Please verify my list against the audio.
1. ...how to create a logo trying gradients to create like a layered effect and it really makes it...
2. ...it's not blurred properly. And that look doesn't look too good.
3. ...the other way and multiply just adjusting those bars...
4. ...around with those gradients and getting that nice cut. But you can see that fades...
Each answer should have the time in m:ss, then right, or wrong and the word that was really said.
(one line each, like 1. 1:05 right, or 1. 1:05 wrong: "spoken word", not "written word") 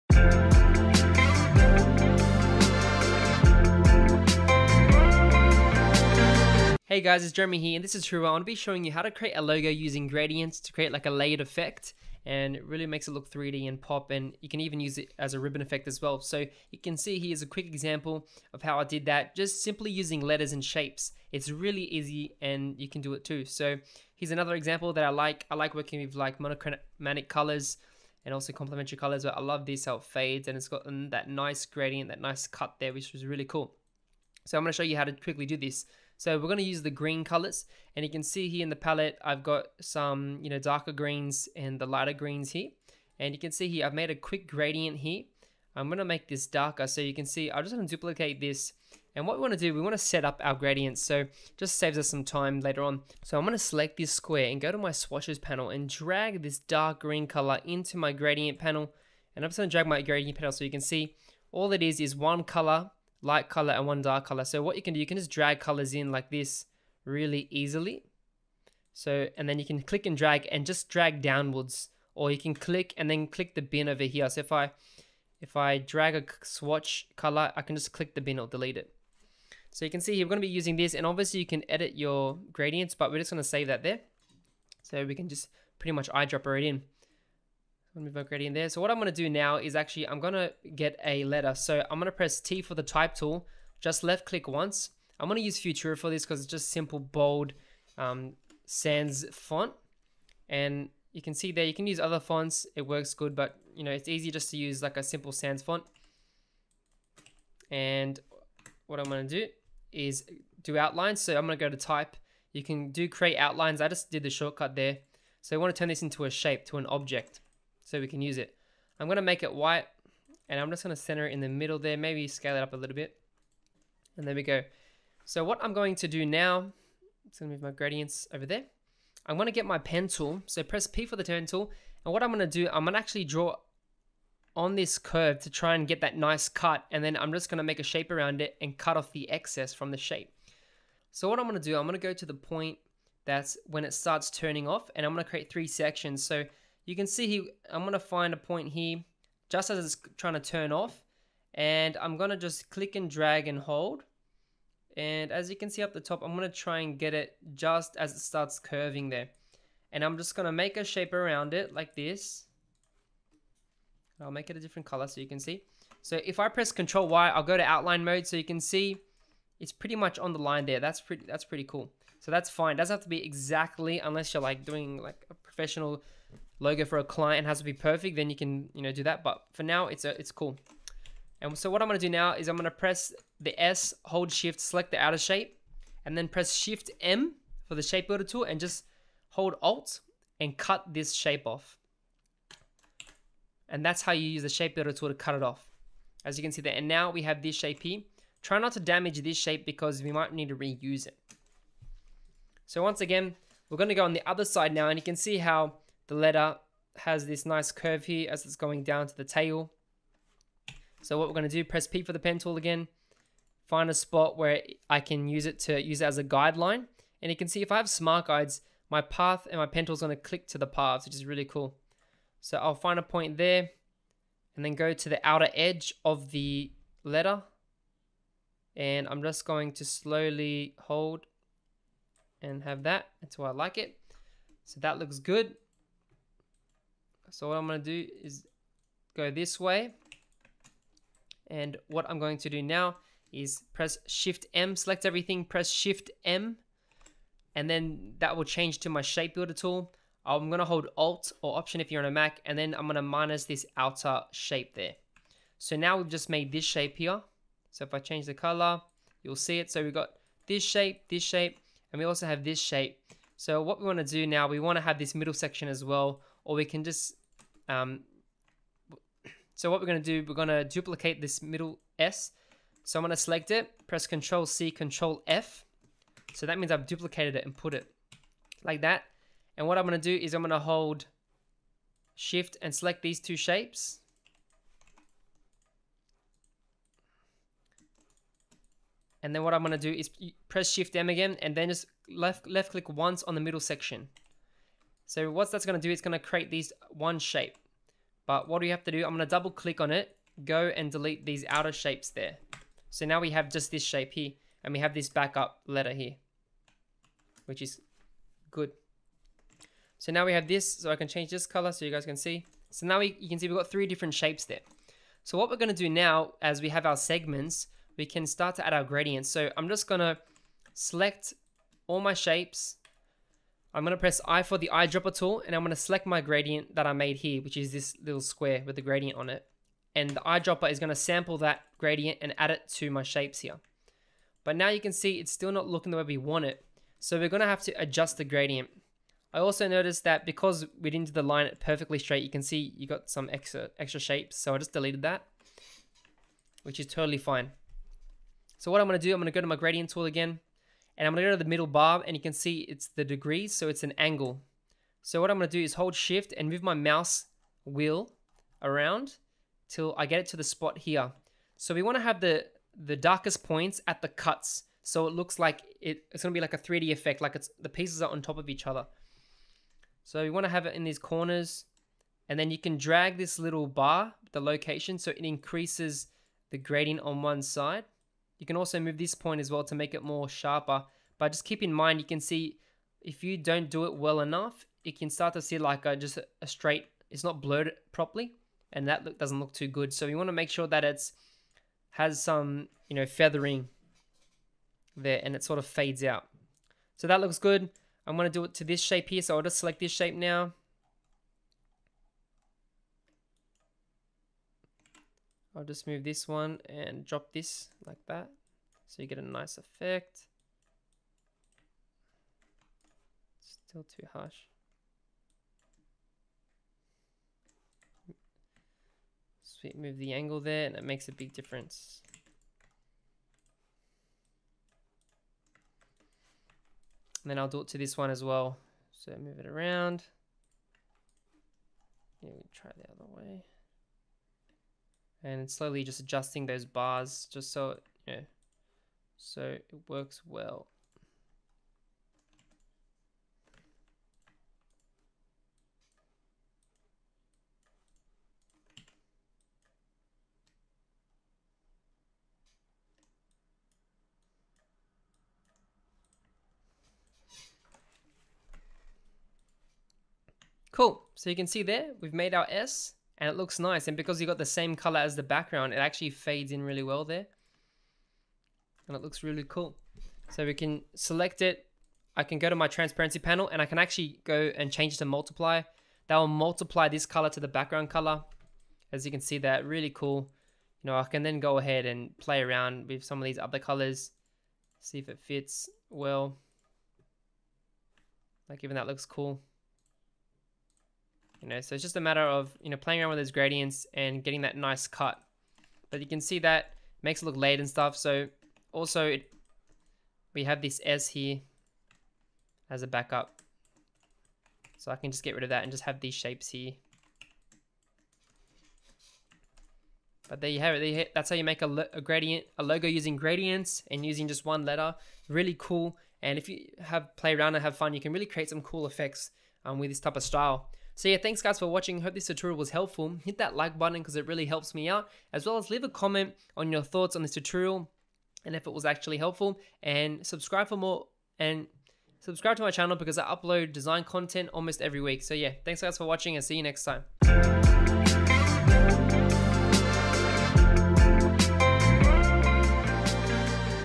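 1. 0:08 wrong: "using", not "trying"
2. 6:27 right
3. 7:12 wrong: "slowly", not "multiply"
4. 8:13 wrong: "makes", not "fades".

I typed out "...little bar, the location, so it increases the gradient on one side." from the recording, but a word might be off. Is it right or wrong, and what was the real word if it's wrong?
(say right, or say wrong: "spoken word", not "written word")
right.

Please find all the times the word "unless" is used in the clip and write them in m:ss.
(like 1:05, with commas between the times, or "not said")
2:53.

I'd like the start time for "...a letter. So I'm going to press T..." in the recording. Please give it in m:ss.
1:31.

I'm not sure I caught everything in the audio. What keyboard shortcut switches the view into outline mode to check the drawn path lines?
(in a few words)
Control Y.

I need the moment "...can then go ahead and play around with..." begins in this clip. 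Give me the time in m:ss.
8:01.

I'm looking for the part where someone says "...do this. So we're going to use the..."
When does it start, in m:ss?
0:35.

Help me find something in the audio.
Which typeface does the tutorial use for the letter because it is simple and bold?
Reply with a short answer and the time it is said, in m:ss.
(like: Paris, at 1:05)
Futura, at 1:35.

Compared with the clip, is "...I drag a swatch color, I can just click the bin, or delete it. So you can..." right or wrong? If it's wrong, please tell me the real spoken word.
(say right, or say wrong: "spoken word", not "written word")
right.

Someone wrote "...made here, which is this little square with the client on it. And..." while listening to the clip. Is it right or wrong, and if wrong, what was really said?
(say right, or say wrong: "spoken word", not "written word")
wrong: "gradient", not "client".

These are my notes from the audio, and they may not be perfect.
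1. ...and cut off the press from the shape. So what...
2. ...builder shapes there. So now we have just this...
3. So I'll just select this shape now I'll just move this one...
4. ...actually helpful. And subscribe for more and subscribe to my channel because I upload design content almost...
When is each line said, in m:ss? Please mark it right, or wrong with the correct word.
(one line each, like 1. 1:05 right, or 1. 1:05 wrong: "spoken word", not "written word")
1. 2:18 wrong: "excess", not "press"
2. 5:01 wrong: "outer", not "builder"
3. 6:39 right
4. 8:48 right.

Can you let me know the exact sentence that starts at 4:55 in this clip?
So what that's going to do, it's going to create these one shape.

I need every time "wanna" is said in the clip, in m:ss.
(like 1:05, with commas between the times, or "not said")
6:01, 6:10.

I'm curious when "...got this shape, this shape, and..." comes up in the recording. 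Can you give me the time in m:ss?
4:19.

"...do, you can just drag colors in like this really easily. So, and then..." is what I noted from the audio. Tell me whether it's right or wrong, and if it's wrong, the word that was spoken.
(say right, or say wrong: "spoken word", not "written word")
right.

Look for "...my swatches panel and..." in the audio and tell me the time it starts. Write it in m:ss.
0:54.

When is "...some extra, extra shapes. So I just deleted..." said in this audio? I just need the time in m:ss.
5:43.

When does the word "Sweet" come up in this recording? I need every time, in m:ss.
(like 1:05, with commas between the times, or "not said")
6:59.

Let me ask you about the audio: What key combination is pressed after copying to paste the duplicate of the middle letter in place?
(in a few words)
Control F.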